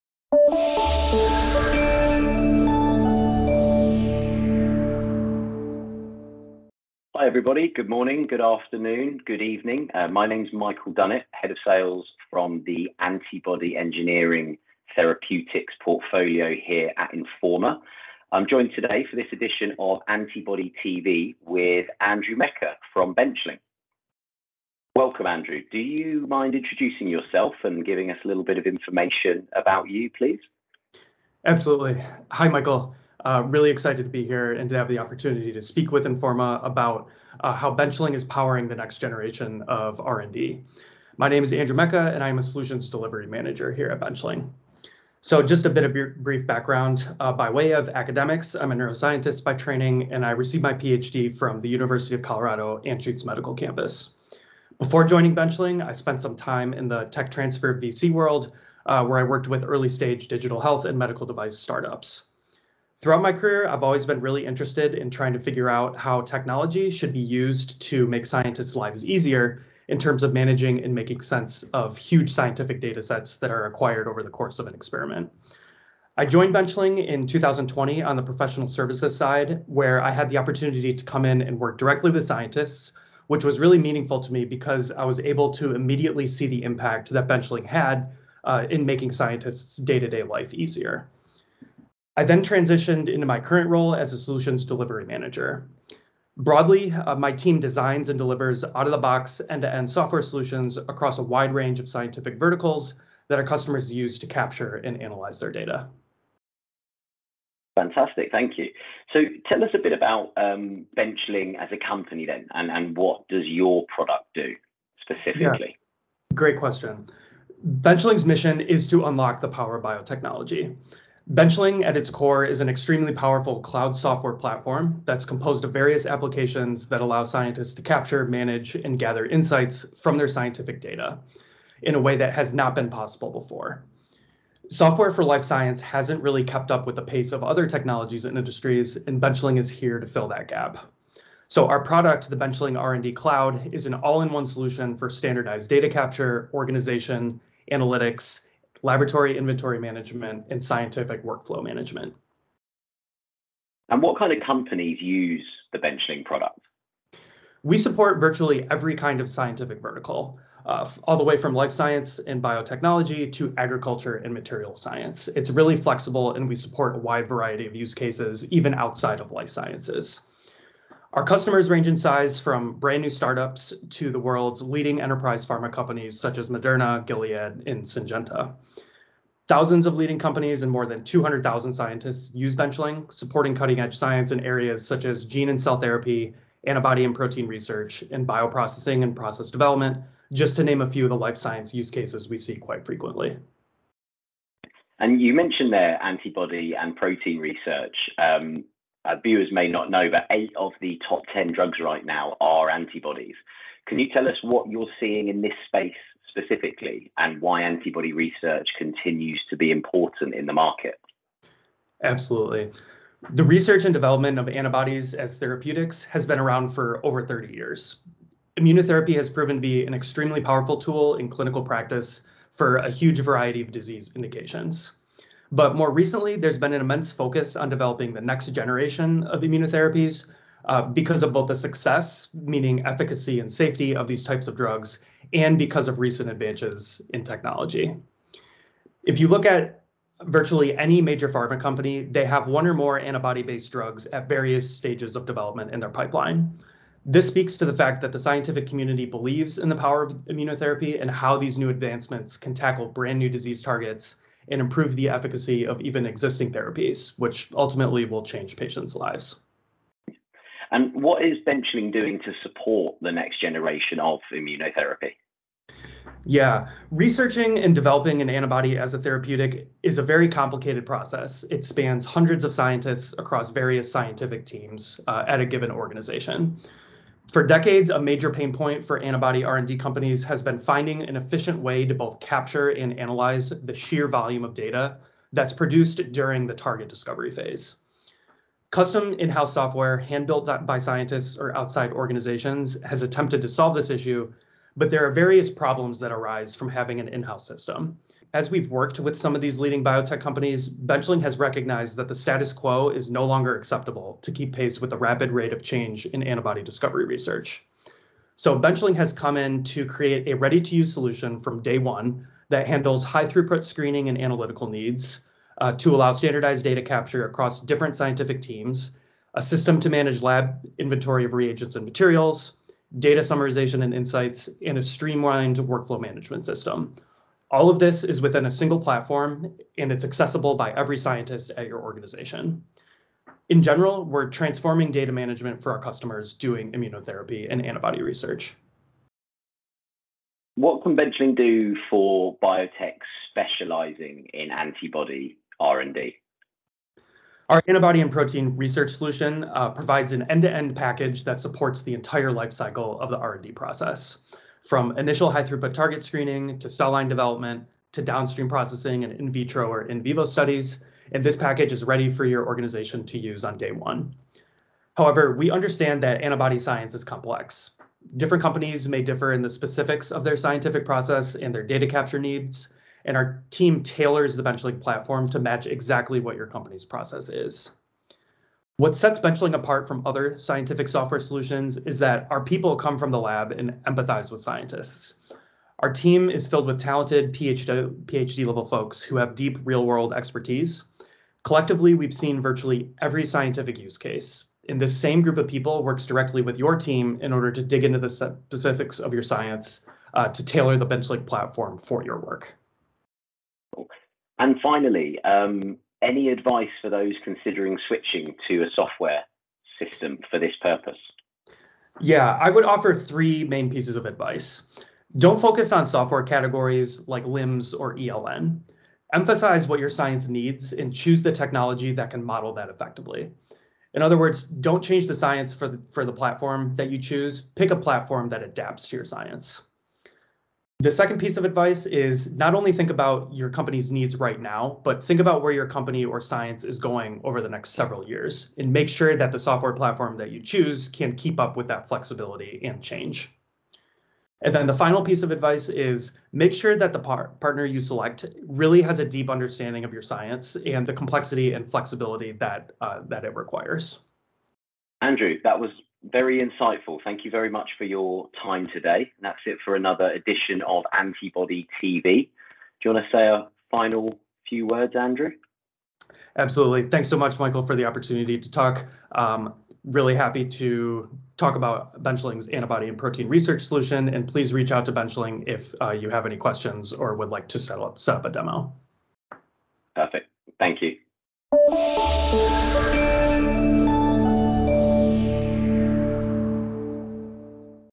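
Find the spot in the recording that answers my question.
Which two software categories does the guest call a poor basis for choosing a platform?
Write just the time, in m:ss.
6:57.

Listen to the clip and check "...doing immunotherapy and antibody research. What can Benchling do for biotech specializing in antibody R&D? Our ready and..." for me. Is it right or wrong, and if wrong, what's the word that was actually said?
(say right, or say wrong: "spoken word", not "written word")
wrong: "antibody", not "ready".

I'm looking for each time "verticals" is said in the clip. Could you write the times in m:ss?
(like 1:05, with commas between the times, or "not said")
1:42, 2:39.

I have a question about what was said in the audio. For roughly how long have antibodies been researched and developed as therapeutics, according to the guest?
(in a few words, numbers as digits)
Over 30 years.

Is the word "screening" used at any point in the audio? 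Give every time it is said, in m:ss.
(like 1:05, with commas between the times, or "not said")
5:13, 5:56.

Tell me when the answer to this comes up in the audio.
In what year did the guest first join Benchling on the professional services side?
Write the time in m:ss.
1:17.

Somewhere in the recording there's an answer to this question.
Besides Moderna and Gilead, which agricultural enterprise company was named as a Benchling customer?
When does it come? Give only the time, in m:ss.
2:57.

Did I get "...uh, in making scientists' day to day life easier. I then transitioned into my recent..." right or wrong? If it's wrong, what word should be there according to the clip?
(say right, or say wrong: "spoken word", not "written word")
wrong: "current", not "recent".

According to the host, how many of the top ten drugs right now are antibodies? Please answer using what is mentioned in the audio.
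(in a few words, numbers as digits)
8.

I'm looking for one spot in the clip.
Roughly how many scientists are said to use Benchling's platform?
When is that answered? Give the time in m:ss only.
3:00.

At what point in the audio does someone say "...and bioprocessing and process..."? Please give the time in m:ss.
3:08.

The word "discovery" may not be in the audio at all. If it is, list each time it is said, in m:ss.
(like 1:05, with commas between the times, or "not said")
4:46, 5:06.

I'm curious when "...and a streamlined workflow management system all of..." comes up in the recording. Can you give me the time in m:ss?
5:24.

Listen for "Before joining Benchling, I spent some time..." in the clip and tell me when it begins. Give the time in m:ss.
0:54.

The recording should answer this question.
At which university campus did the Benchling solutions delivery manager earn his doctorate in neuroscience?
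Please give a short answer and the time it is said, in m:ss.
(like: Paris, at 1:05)
University of Colorado Anschutz Medical Campus, at 0:51.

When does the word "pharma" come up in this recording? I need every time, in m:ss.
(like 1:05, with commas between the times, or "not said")
2:55, 4:01.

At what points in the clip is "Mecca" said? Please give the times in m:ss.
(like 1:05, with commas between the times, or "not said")
0:22, 0:41.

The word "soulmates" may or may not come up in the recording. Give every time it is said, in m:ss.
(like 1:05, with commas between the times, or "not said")
not said.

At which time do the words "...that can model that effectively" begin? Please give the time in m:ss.
7:01.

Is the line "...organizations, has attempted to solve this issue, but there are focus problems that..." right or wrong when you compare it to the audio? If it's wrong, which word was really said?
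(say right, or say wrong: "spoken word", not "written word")
wrong: "various", not "focus".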